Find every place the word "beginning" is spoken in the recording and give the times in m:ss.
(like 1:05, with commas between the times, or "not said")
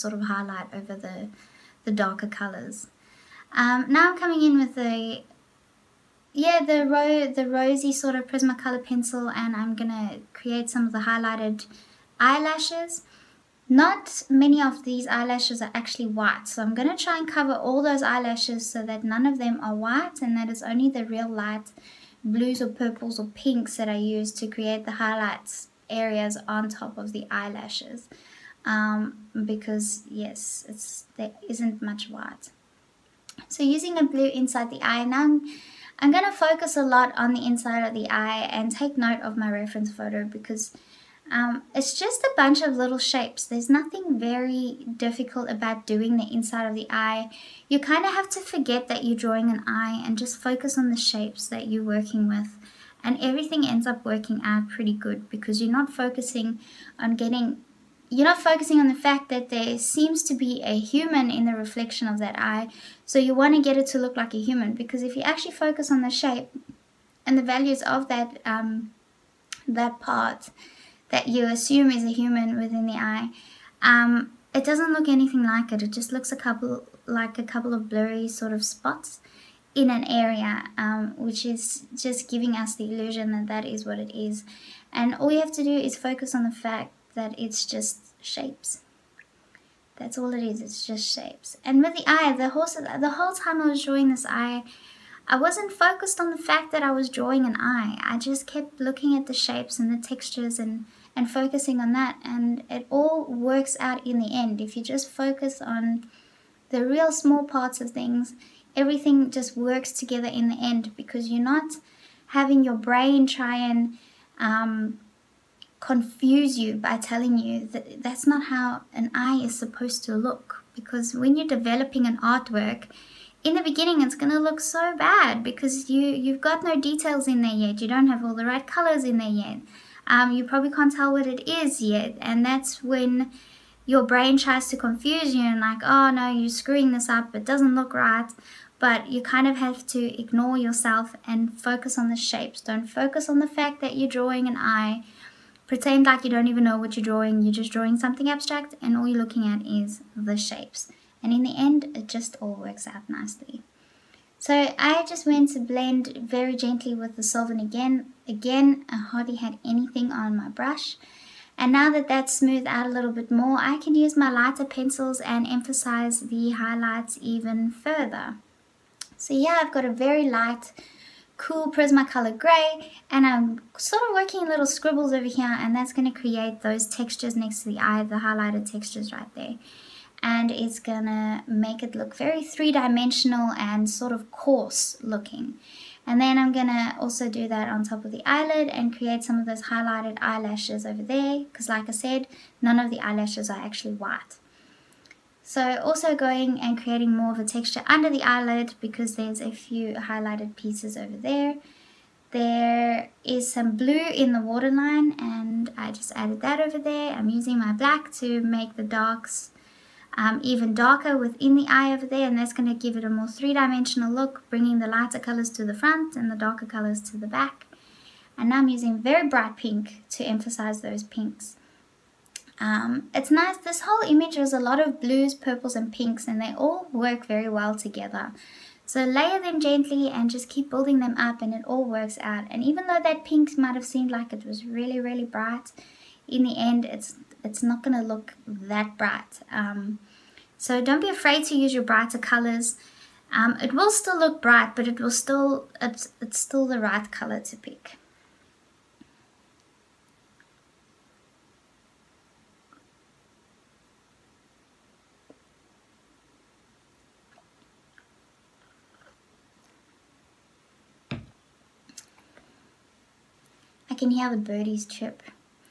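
2:03.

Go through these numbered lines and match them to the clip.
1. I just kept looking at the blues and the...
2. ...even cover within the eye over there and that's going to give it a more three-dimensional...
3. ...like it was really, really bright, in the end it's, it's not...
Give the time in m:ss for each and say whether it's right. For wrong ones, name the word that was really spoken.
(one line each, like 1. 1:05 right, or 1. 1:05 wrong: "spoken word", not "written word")
1. 1:38 wrong: "shapes", not "blues"
2. 3:30 wrong: "darker", not "cover"
3. 3:54 right.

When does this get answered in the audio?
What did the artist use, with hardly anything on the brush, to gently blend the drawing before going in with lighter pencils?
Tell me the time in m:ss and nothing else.
2:37.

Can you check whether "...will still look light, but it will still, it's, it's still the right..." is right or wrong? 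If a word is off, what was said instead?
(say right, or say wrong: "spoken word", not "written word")
wrong: "bright", not "light".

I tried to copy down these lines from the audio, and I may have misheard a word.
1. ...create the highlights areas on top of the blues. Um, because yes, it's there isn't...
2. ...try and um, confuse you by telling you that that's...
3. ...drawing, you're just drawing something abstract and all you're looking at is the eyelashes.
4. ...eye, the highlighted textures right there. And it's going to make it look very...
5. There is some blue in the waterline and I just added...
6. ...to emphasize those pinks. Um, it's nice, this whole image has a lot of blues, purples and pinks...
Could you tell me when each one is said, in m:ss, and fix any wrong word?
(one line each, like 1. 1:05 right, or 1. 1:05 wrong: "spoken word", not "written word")
1. 0:24 wrong: "eyelashes", not "blues"
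2. 1:53 right
3. 2:27 wrong: "shapes", not "eyelashes"
4. 2:57 right
5. 3:22 right
6. 3:40 right.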